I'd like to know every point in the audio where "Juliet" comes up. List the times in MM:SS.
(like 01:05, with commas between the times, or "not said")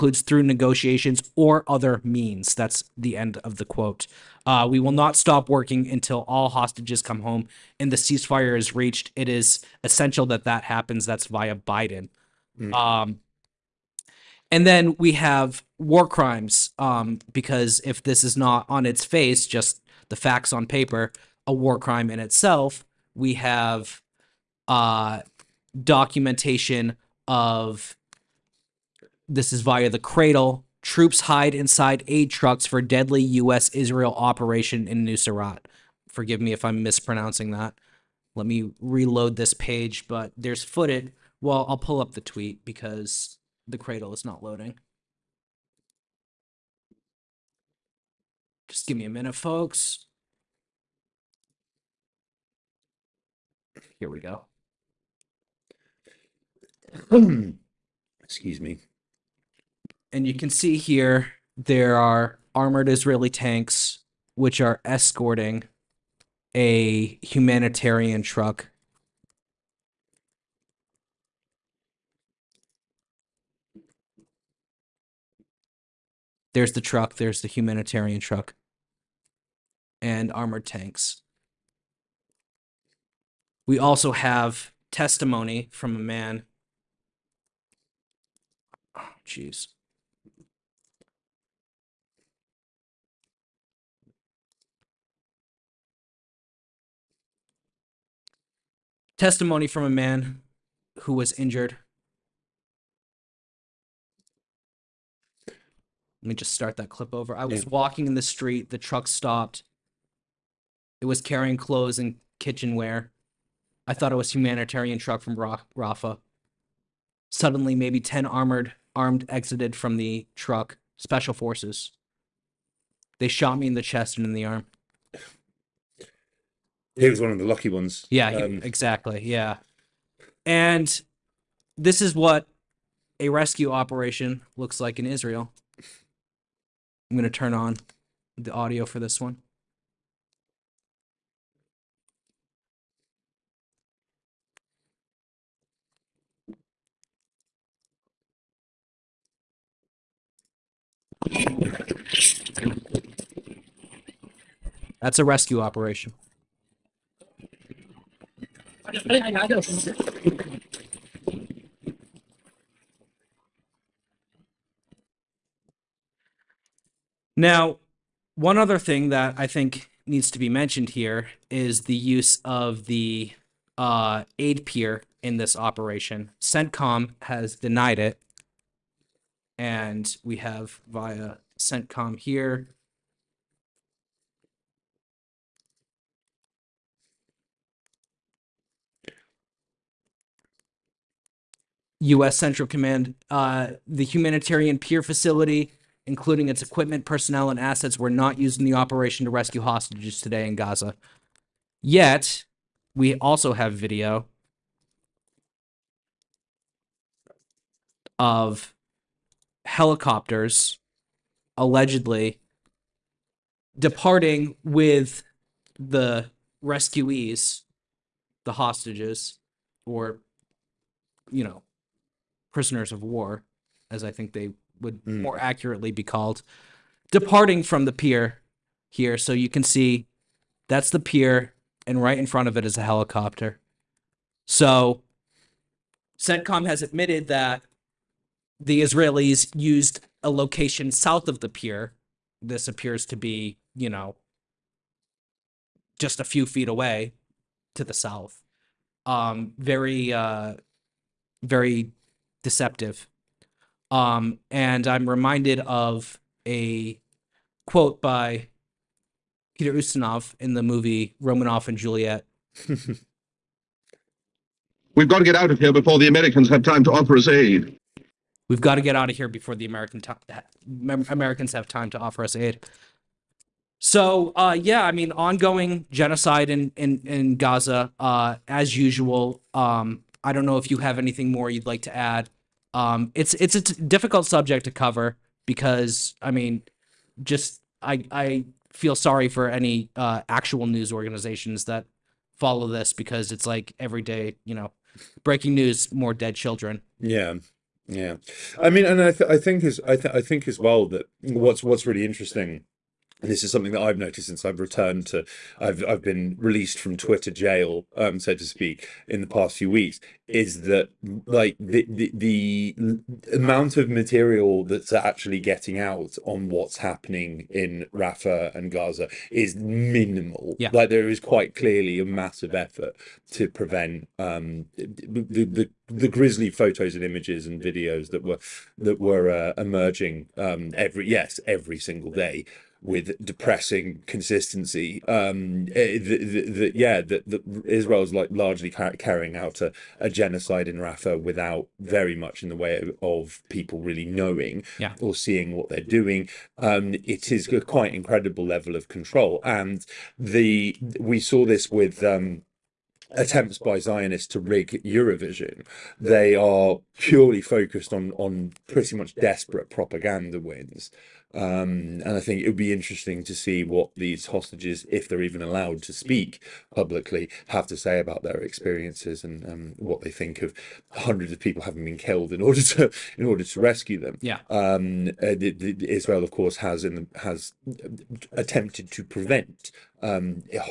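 04:21.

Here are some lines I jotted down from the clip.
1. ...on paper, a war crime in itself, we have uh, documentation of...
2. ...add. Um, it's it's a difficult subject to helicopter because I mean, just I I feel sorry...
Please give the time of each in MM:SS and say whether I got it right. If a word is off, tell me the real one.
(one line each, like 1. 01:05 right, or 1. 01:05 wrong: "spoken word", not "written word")
1. 00:20 right
2. 04:41 wrong: "cover", not "helicopter".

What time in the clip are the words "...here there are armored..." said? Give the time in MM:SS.
01:00.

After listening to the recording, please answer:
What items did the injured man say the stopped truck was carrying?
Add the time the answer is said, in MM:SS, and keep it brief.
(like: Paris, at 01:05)
Clothes and kitchenware, at 01:51.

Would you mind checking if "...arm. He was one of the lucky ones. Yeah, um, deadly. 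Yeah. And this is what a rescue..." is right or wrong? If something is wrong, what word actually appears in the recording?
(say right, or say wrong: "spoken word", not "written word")
wrong: "exactly", not "deadly".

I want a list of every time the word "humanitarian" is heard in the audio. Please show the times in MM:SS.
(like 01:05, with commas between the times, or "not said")
01:07, 01:17, 01:54, 03:14.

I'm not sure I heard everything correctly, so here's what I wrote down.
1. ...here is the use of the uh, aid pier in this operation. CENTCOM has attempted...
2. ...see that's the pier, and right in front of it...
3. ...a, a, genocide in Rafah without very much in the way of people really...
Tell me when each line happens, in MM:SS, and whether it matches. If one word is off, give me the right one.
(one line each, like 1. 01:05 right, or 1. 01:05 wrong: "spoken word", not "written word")
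1. 02:50 wrong: "denied", not "attempted"
2. 03:49 right
3. 05:39 right.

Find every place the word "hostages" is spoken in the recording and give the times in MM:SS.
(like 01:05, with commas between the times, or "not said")
00:06, 03:19, 03:38, 06:04.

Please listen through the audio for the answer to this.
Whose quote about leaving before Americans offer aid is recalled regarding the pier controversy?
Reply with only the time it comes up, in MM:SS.
04:19.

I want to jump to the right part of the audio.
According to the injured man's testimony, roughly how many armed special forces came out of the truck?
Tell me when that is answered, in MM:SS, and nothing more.
01:57.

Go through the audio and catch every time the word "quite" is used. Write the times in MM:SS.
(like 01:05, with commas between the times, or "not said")
05:21, 05:47.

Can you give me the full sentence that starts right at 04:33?
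So uh, yeah, I mean, ongoing genocide in in in Gaza uh, as usual.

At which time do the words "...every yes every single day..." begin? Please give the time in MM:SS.
05:30.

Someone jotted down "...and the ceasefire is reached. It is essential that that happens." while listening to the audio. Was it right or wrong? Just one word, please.
right.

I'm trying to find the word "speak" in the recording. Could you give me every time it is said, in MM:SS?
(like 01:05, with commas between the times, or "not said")
05:08, 06:05.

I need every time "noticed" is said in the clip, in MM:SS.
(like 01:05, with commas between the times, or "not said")
05:03.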